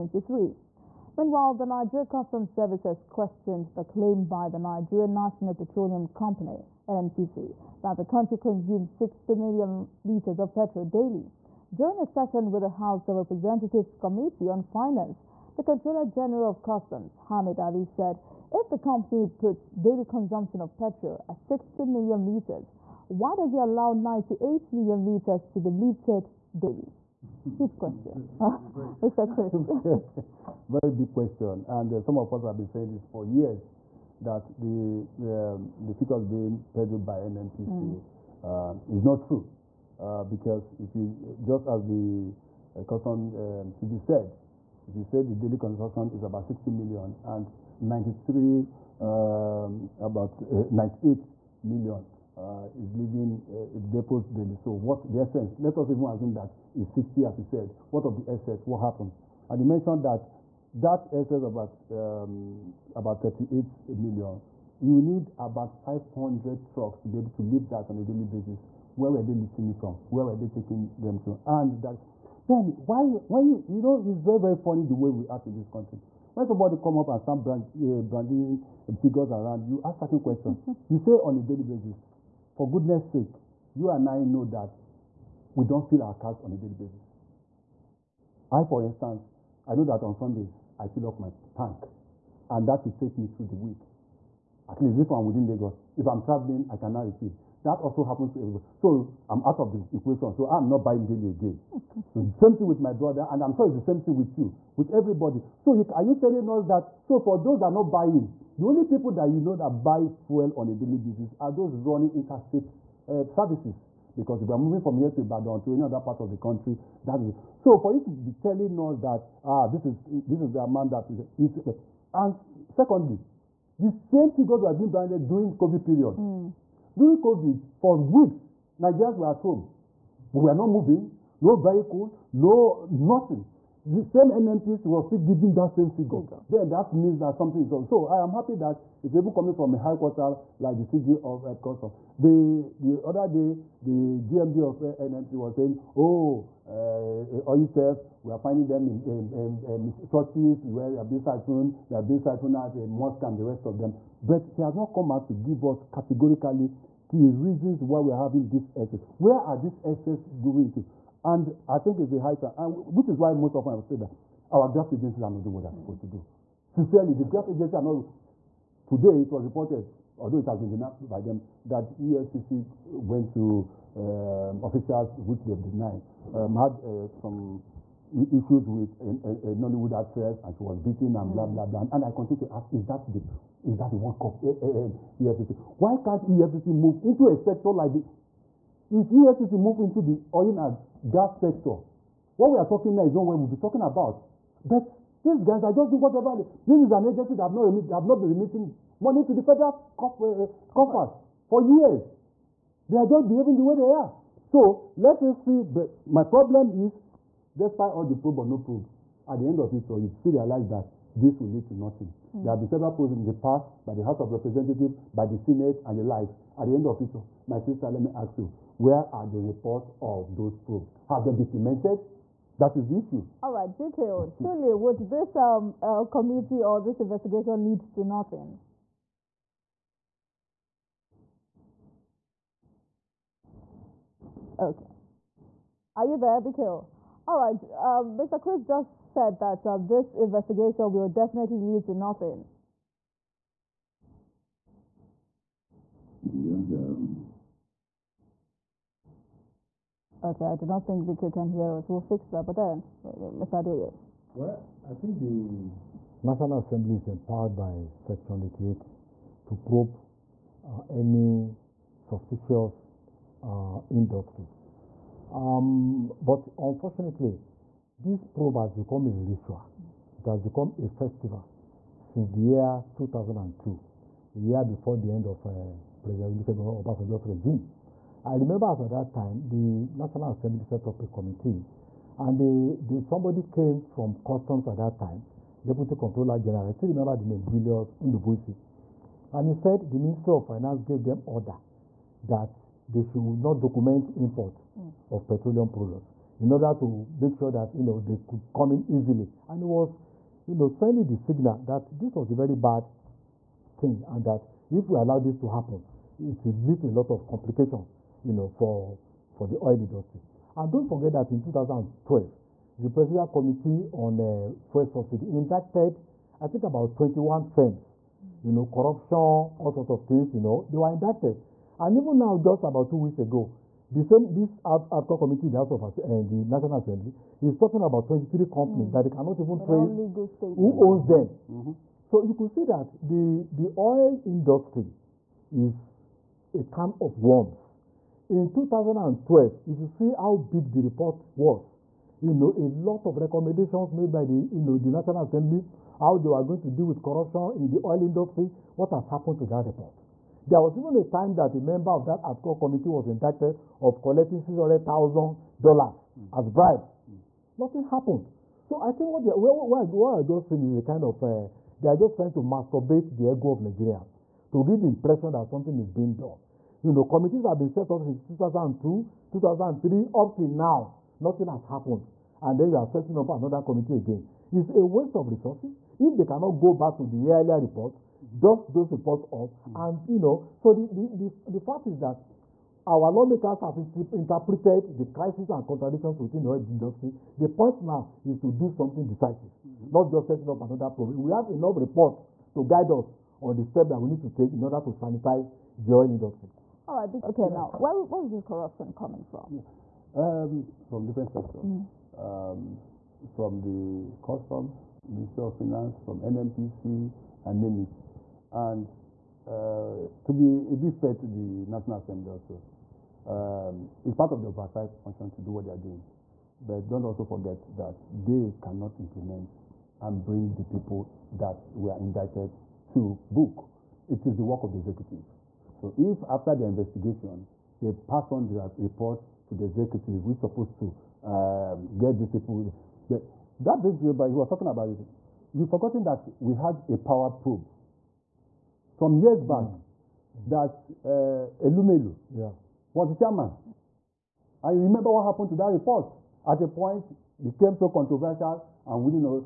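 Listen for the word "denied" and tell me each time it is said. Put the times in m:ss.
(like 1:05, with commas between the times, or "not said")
2:50, 2:55.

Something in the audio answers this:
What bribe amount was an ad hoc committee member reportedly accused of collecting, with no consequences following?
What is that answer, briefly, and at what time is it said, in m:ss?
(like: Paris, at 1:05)
$600,000, at 5:54.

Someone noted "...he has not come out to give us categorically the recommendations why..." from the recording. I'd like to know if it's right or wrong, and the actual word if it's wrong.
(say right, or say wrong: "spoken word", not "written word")
wrong: "reasons", not "recommendations".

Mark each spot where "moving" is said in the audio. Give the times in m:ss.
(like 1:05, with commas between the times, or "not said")
1:54, 2:10.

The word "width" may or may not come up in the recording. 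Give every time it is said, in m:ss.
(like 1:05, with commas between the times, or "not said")
not said.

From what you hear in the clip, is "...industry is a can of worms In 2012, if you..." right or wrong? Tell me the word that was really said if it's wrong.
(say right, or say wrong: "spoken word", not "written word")
right.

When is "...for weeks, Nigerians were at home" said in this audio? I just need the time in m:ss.
2:07.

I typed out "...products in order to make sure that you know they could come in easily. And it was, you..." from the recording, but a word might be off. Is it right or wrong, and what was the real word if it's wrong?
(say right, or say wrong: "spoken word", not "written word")
right.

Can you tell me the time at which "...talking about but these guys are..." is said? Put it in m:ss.
3:13.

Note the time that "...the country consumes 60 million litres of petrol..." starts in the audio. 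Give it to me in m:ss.
0:07.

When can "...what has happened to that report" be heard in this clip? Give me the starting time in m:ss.
5:48.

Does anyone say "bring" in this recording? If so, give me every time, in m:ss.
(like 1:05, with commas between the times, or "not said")
7:00, 7:13.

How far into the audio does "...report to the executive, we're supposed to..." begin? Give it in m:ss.
7:08.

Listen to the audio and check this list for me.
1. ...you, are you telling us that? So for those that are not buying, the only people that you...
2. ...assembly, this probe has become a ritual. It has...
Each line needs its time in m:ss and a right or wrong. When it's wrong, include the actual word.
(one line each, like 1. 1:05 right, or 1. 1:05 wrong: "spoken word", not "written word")
1. 1:45 right
2. 4:26 wrong: "unfortunately", not "assembly".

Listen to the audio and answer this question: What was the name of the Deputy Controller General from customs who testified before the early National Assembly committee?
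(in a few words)
Julius Ndubuisi.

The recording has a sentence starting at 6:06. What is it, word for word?
You know, committees have been set up since 2002, 2003, up till now.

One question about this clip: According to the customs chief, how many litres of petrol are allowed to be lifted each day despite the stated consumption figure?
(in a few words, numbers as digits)
98 million litres.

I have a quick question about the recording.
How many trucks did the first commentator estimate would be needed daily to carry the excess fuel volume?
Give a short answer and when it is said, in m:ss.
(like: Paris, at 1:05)
500, at 1:05.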